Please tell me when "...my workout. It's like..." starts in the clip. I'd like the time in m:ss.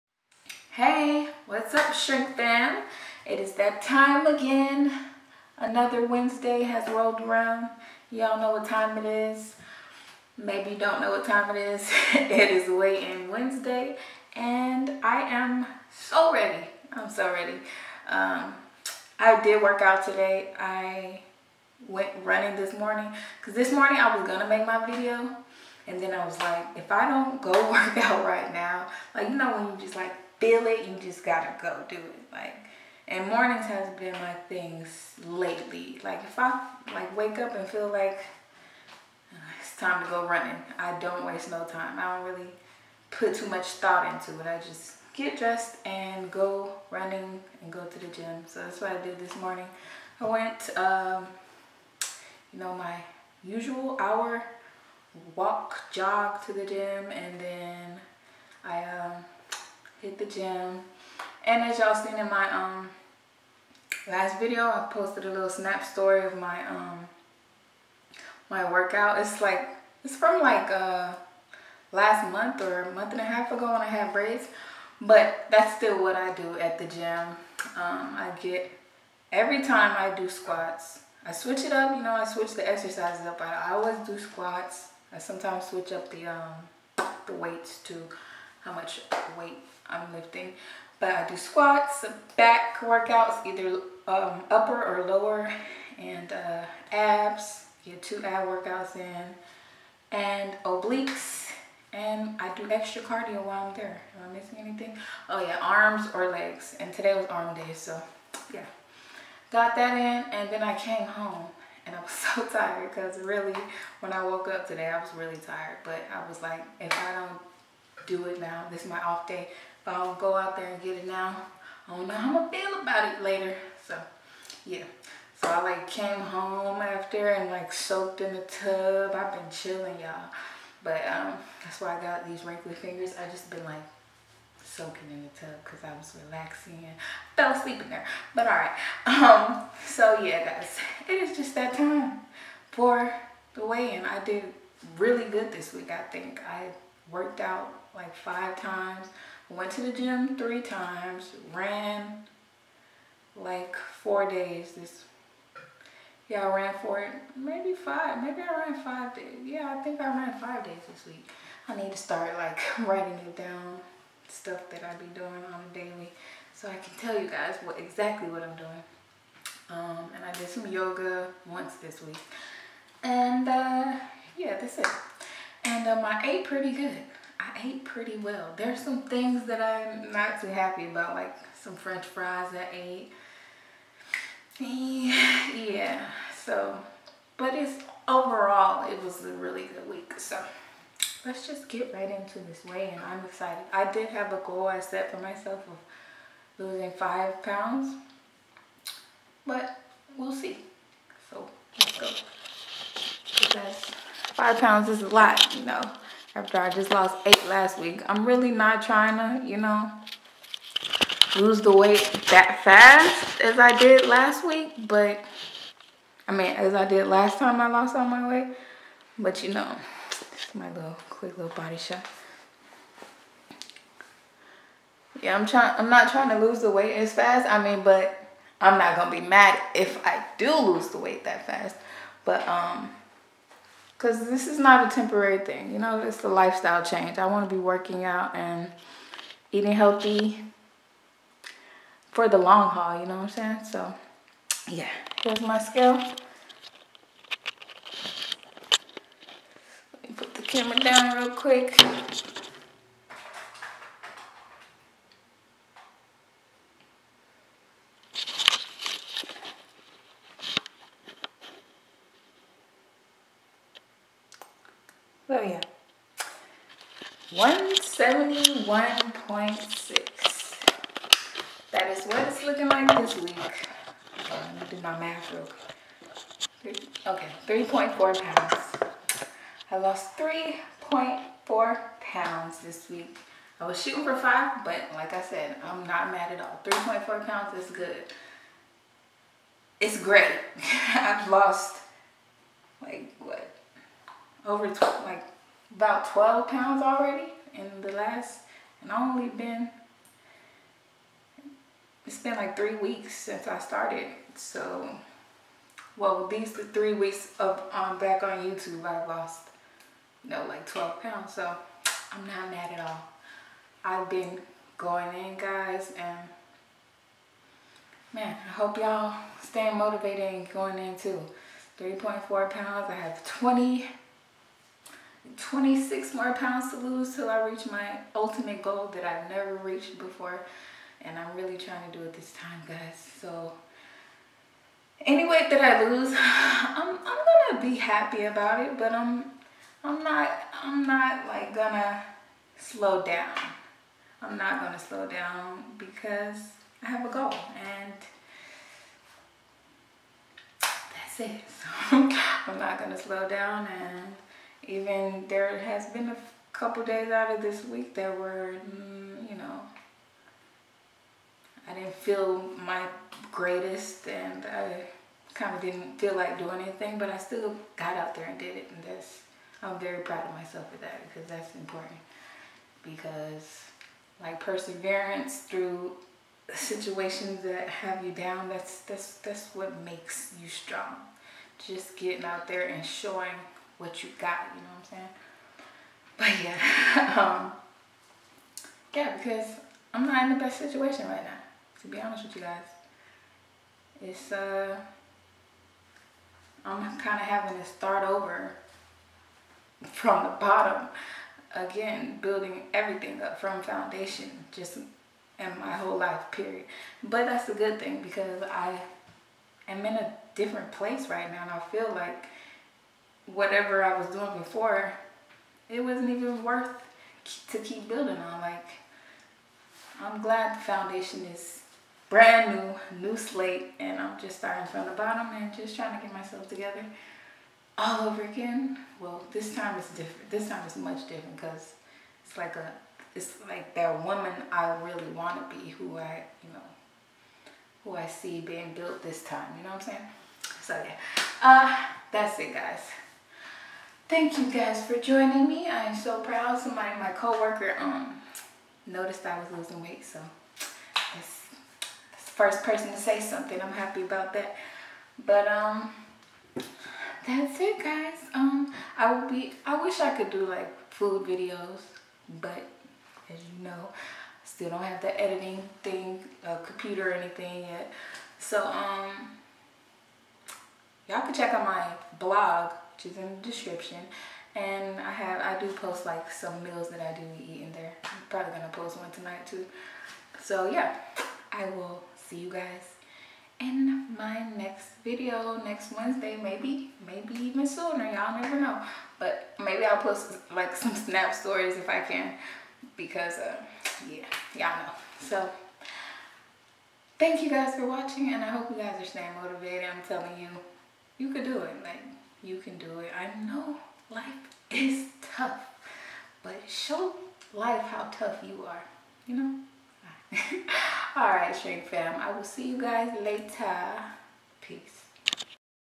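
1:08.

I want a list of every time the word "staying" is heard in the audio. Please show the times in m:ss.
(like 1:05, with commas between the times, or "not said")
5:19, 8:19.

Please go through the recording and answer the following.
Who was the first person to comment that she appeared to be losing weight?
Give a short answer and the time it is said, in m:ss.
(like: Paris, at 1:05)
coworker, at 7:27.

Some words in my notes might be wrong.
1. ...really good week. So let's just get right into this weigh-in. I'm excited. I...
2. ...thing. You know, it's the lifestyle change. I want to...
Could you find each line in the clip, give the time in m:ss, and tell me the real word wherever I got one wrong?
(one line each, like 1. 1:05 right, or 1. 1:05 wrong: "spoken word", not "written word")
1. 3:09 right
2. 3:55 right.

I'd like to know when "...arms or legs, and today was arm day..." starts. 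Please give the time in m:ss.
1:45.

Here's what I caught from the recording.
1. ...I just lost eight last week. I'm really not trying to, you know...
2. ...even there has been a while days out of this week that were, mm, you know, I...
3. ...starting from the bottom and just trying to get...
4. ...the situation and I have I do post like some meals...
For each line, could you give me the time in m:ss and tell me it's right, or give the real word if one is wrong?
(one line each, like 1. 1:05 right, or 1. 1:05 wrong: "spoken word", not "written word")
1. 3:26 right
2. 5:54 wrong: "couple", not "while"
3. 7:04 right
4. 7:53 wrong: "description", not "situation".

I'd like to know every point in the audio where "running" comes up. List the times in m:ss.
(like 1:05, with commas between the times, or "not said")
0:22, 0:40, 0:46.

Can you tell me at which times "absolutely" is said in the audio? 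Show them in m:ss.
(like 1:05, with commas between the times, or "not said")
not said.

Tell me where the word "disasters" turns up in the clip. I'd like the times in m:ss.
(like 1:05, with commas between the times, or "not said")
not said.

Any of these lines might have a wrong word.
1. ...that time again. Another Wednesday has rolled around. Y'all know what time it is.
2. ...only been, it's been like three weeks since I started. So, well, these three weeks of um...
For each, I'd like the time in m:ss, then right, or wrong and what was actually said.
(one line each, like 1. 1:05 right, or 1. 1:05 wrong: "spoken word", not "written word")
1. 0:03 right
2. 4:59 right.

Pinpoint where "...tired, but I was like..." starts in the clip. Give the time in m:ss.
1:55.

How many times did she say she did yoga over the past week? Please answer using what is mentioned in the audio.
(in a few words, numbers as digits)
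once.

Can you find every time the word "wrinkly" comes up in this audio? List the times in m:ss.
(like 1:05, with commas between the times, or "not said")
2:12.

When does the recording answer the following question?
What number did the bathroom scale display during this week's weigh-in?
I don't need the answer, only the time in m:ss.
4:27.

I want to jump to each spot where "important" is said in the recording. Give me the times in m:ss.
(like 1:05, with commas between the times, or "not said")
6:11.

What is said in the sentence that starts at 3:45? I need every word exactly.
Yeah, I'm trying, I'm not trying to lose the weight as fast.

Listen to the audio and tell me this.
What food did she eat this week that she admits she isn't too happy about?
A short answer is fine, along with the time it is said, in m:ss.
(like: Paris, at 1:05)
french fries, at 3:01.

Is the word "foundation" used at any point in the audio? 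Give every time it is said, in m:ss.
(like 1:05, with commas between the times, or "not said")
6:43, 7:00.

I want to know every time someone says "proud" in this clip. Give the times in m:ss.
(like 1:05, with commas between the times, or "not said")
6:10, 7:26.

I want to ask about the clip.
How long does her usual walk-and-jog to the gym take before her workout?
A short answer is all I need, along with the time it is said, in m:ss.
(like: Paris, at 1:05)
hour, at 0:53.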